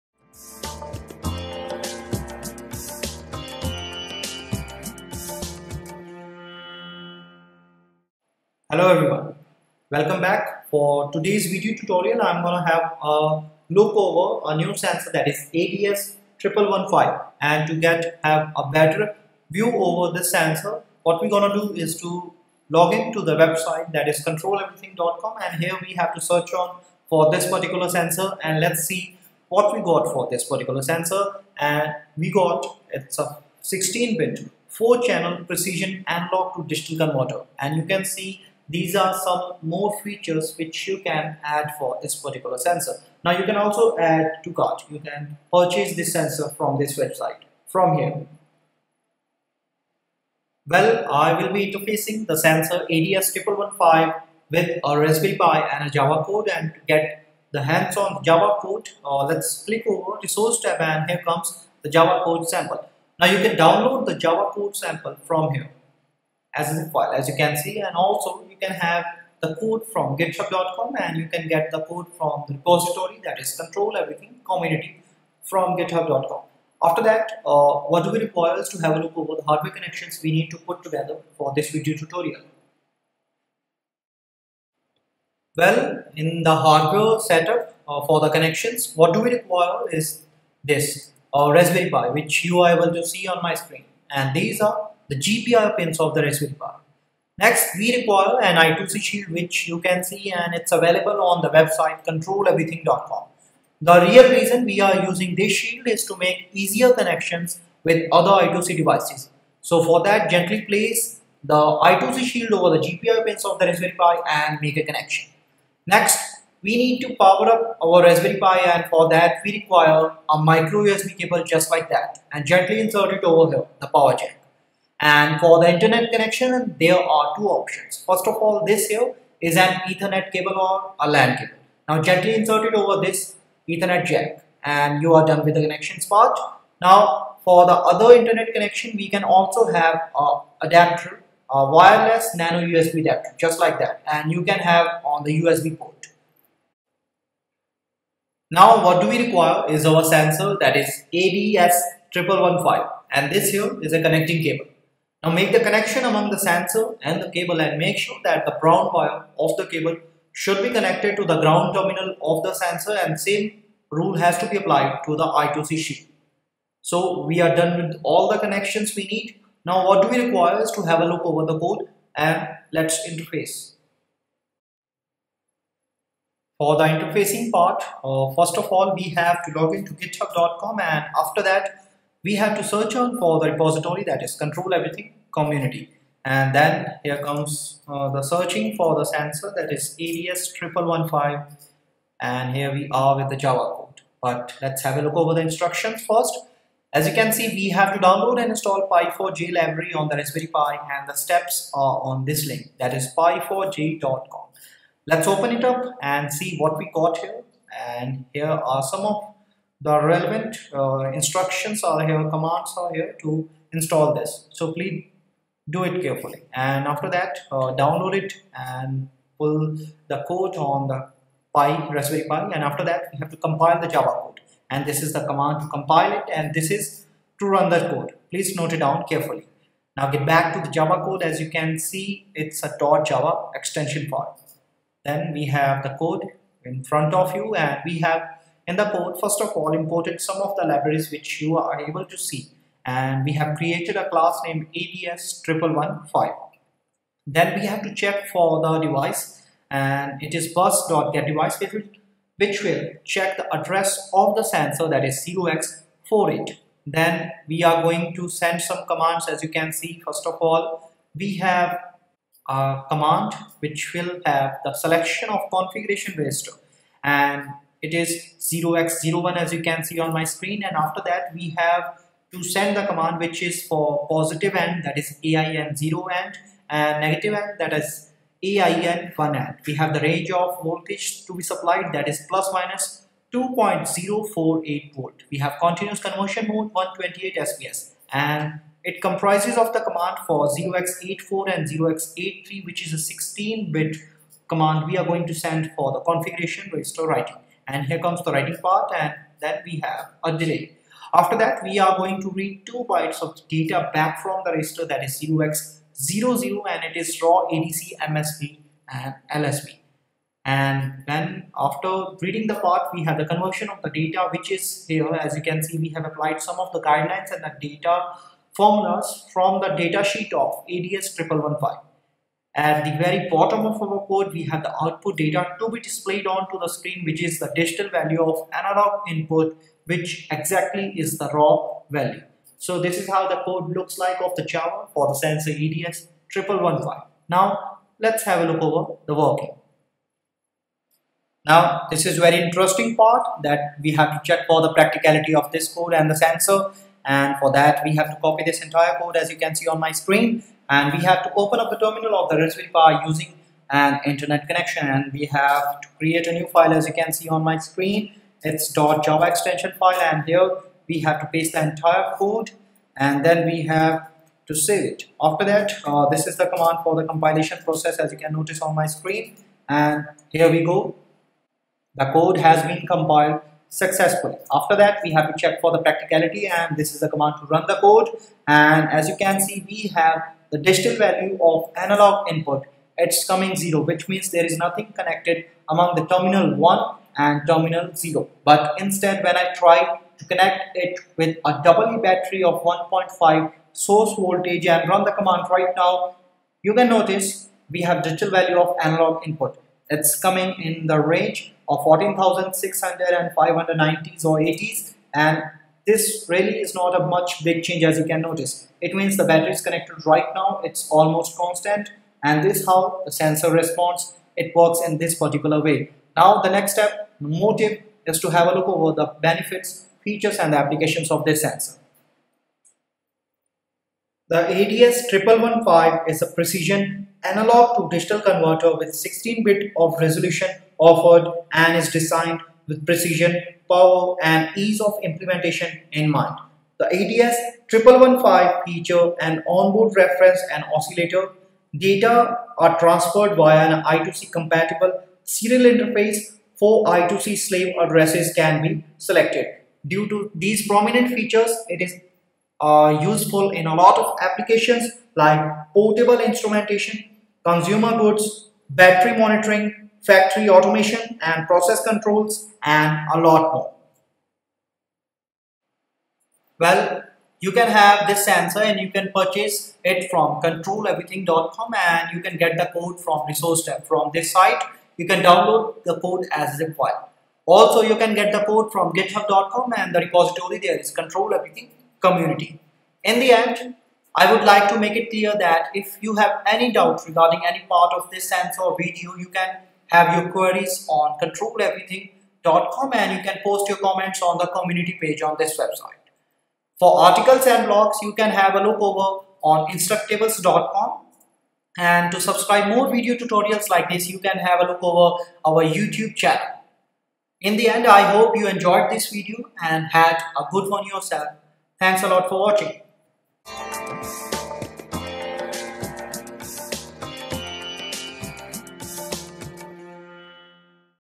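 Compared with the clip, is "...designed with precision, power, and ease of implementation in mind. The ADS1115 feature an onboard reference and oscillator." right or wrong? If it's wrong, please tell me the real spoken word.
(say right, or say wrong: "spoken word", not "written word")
right.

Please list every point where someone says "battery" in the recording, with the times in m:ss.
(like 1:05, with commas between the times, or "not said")
6:32, 6:49, 7:38.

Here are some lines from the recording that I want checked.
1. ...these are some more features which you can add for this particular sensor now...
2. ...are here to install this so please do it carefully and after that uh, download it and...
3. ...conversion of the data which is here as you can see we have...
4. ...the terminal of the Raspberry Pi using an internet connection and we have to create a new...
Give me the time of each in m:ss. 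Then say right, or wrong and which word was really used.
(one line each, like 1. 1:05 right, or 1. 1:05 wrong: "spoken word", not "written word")
1. 0:38 right
2. 3:32 right
3. 5:13 right
4. 5:51 right.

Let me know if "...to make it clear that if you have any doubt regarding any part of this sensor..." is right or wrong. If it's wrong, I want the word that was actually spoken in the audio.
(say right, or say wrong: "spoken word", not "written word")
right.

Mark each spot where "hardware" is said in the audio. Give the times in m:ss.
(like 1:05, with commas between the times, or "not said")
1:19, 1:26.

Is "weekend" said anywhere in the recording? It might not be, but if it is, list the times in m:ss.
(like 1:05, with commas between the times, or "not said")
not said.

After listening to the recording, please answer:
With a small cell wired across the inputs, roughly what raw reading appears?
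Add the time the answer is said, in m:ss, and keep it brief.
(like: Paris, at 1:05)
14,600, at 6:41.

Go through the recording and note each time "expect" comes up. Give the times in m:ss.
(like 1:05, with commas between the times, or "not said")
not said.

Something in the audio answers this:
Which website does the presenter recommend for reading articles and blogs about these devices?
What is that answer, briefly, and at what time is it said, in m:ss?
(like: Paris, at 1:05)
instructables.com, at 8:19.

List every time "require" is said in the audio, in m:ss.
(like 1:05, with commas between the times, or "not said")
1:18, 1:29, 1:37, 1:59, 2:29, 2:50.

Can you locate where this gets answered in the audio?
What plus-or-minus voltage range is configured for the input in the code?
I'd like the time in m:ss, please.
4:42.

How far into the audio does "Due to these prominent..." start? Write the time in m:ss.
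7:29.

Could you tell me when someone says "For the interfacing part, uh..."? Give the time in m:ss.
2:56.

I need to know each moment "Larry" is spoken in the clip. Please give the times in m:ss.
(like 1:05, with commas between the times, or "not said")
not said.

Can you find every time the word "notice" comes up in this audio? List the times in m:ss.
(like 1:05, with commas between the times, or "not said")
6:08, 6:36, 6:48.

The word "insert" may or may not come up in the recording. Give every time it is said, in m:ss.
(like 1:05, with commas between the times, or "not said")
2:02, 2:12.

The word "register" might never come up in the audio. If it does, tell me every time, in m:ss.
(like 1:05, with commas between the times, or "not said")
4:26, 4:56, 5:04.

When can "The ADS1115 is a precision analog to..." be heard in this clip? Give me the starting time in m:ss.
7:04.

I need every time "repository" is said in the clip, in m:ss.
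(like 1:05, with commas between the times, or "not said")
1:12, 3:03, 7:59.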